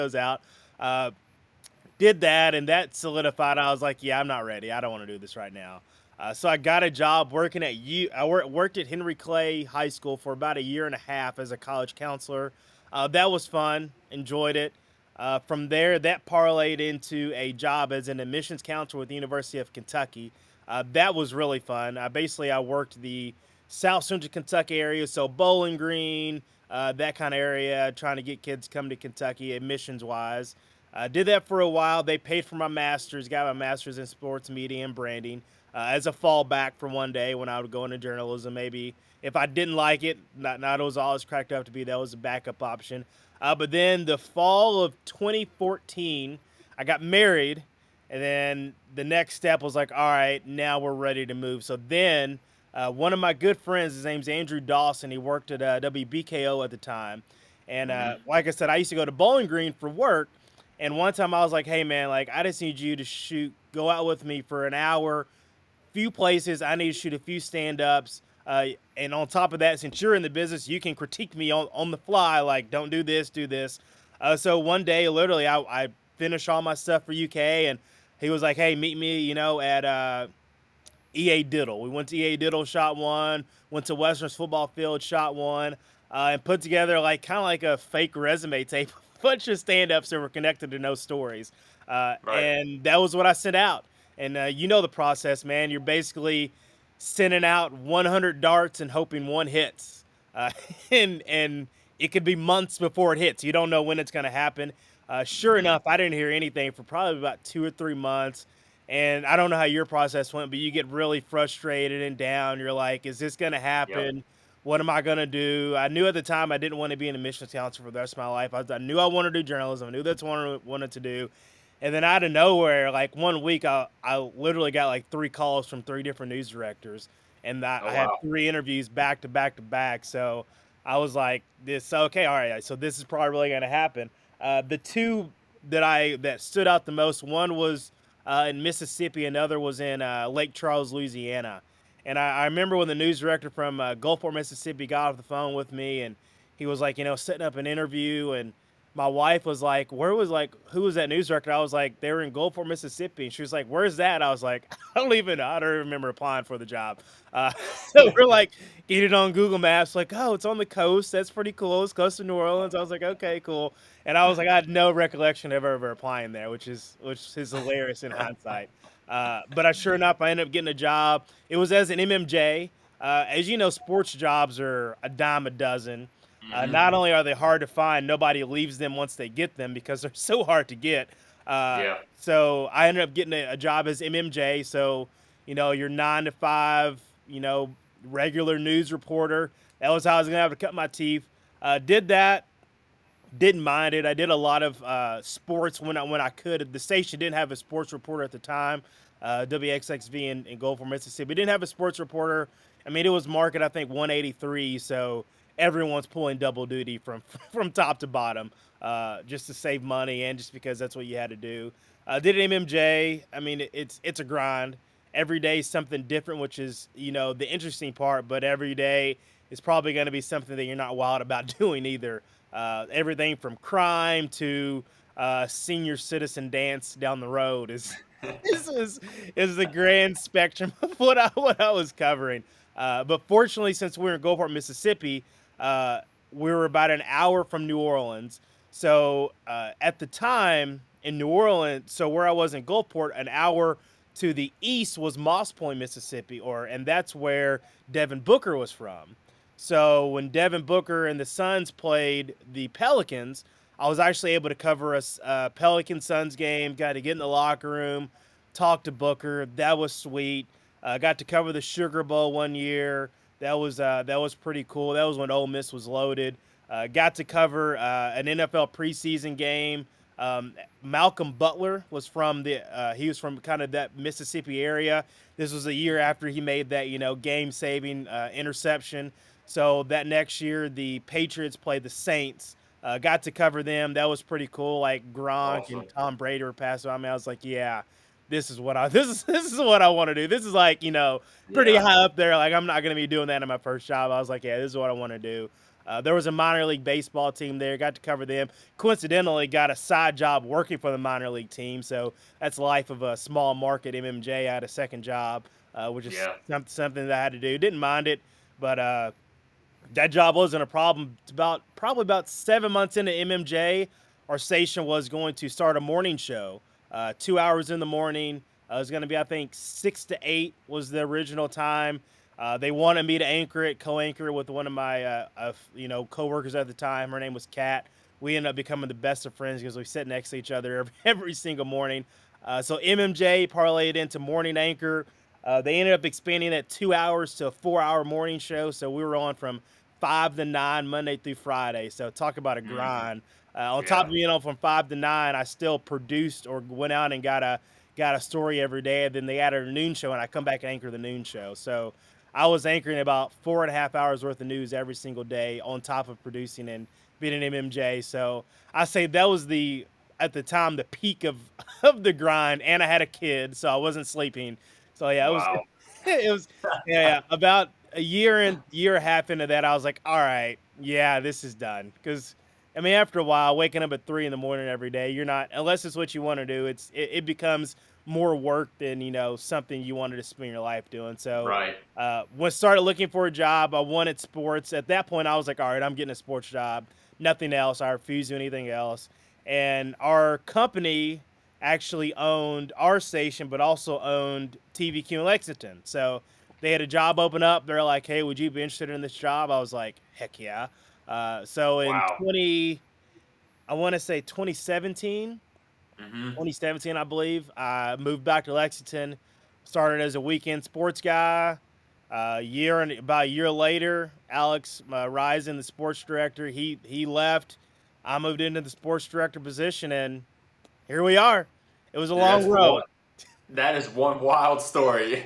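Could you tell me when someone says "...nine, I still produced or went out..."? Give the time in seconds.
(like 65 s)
344 s.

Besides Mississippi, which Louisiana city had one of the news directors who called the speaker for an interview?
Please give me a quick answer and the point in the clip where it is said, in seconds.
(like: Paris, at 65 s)
Lake Charles, at 140 s.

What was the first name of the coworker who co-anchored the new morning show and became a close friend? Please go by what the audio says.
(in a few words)
Kat.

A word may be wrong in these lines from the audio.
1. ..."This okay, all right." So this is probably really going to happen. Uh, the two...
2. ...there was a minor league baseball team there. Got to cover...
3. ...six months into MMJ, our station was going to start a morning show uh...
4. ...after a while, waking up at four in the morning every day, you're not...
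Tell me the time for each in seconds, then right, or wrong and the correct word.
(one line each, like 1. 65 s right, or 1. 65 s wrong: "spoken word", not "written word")
1. 131 s right
2. 296 s right
3. 312 s wrong: "seven", not "six"
4. 372 s wrong: "three", not "four".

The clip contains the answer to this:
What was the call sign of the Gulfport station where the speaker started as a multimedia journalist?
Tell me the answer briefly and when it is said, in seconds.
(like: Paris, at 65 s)
WXXV, at 199 s.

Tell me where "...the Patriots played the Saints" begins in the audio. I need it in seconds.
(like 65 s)
280 s.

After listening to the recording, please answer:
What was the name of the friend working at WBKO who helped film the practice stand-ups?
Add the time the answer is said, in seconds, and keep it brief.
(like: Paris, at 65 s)
Andrew Dawson, at 54 s.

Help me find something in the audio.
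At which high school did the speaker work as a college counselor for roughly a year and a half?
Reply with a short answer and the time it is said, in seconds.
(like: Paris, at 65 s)
Henry Clay High School, at 8 s.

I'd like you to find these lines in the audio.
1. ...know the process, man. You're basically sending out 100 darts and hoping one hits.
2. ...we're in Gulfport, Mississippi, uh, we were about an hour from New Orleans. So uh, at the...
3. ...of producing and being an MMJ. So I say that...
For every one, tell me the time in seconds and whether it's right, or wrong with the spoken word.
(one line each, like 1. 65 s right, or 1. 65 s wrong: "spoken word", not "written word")
1. 94 s right
2. 234 s right
3. 356 s right.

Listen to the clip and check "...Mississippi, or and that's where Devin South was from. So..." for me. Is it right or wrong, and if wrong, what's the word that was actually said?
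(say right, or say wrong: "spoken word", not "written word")
wrong: "Booker", not "South".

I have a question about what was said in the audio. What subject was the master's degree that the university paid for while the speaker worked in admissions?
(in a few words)
sports media and branding.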